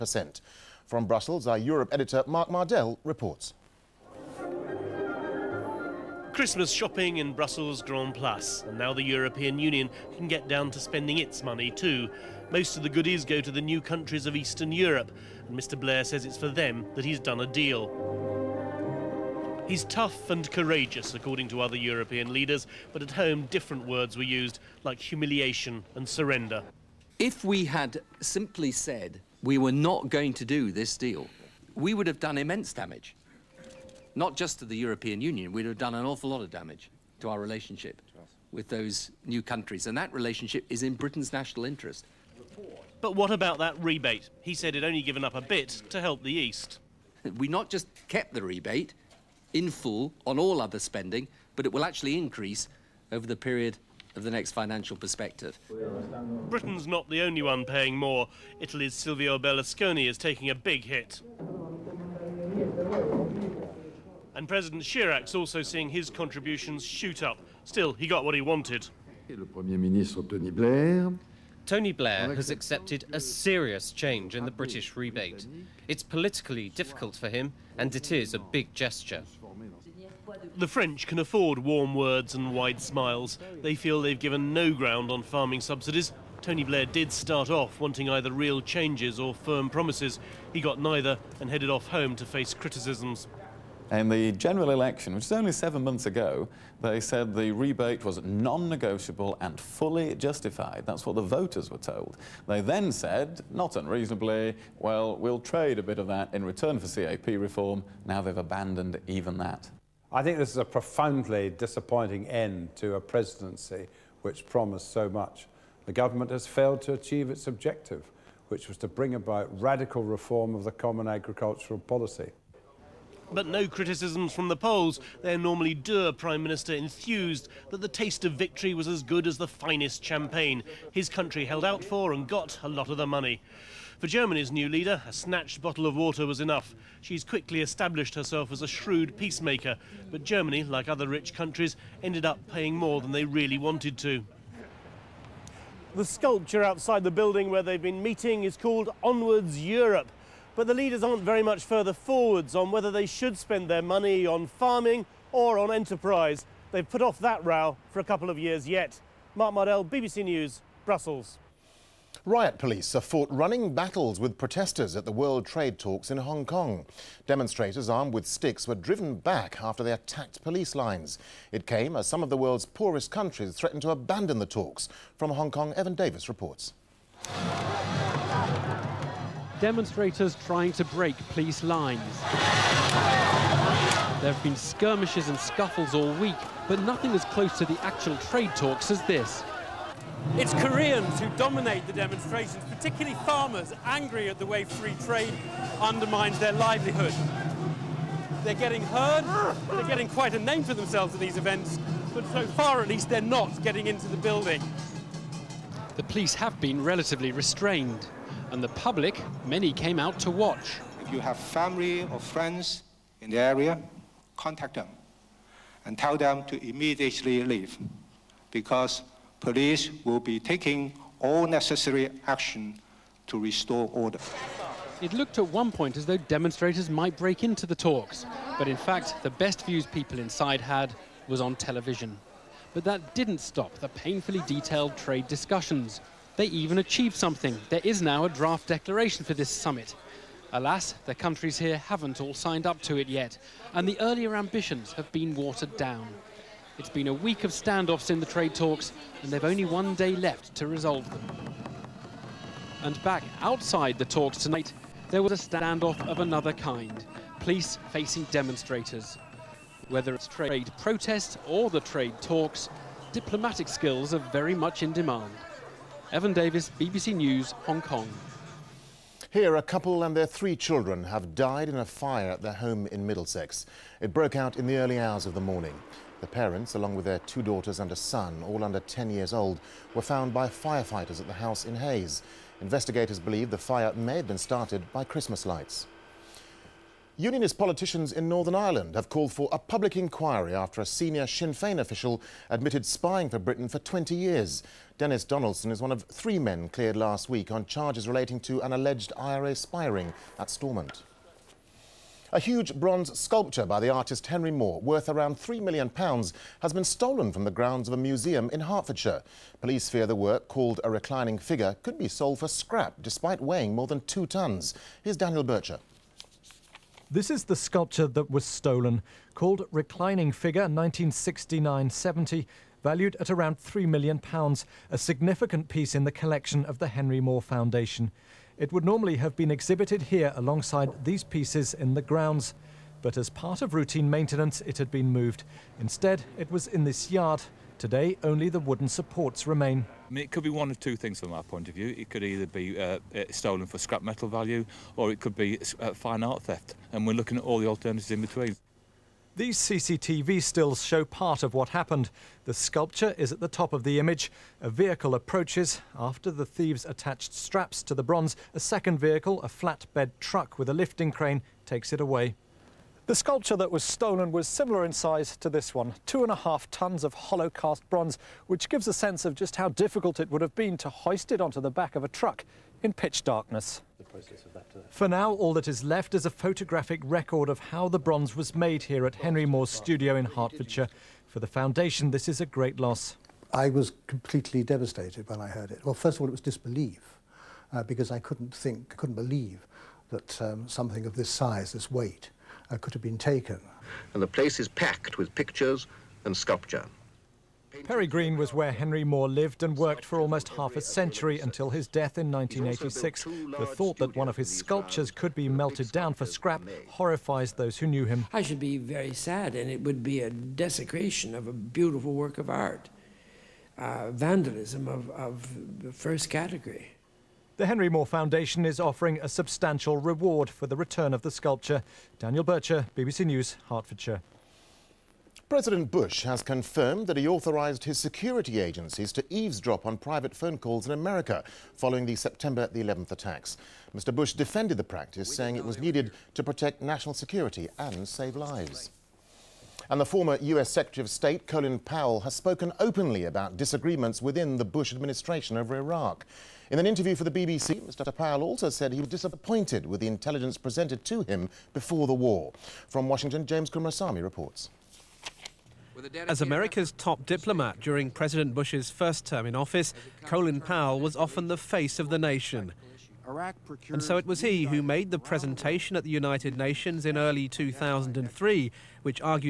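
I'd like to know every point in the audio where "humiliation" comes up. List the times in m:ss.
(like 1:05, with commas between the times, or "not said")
0:25.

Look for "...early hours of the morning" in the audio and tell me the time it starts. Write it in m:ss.
4:34.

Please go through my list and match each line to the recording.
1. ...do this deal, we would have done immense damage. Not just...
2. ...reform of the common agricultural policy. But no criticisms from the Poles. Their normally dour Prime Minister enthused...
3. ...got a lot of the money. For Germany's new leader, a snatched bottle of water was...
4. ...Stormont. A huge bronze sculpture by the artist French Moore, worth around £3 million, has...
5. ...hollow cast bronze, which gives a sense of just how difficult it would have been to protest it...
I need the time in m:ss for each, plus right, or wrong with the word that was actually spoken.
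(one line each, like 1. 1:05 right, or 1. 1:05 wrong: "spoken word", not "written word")
1. 0:30 right
2. 2:00 right
3. 2:12 right
4. 5:00 wrong: "Henry", not "French"
5. 6:07 wrong: "hoist", not "protest".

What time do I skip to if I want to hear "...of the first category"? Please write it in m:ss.
6:55.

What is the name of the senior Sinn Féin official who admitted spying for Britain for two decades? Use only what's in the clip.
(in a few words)
Dennis Donaldson.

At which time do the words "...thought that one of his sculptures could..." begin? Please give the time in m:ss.
6:43.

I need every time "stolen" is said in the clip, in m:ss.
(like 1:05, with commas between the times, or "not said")
5:06, 5:18, 5:43, 6:03.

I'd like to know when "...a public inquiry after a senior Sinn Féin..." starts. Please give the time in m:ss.
4:49.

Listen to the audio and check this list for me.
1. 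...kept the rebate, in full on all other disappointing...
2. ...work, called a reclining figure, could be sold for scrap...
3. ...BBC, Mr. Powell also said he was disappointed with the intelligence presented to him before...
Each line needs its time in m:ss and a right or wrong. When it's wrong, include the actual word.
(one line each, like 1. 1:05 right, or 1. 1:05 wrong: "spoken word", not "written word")
1. 0:48 wrong: "spending", not "disappointing"
2. 5:10 right
3. 7:27 right.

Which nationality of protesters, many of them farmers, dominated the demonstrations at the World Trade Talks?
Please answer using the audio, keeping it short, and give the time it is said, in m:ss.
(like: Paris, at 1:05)
Koreans, at 3:10.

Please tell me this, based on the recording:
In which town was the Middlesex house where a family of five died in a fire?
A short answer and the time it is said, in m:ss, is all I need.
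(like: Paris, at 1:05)
Hayes, at 4:41.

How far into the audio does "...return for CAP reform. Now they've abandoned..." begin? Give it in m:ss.
1:46.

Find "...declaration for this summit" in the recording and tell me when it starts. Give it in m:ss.
3:58.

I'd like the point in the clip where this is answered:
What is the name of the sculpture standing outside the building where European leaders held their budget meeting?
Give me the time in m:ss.
2:29.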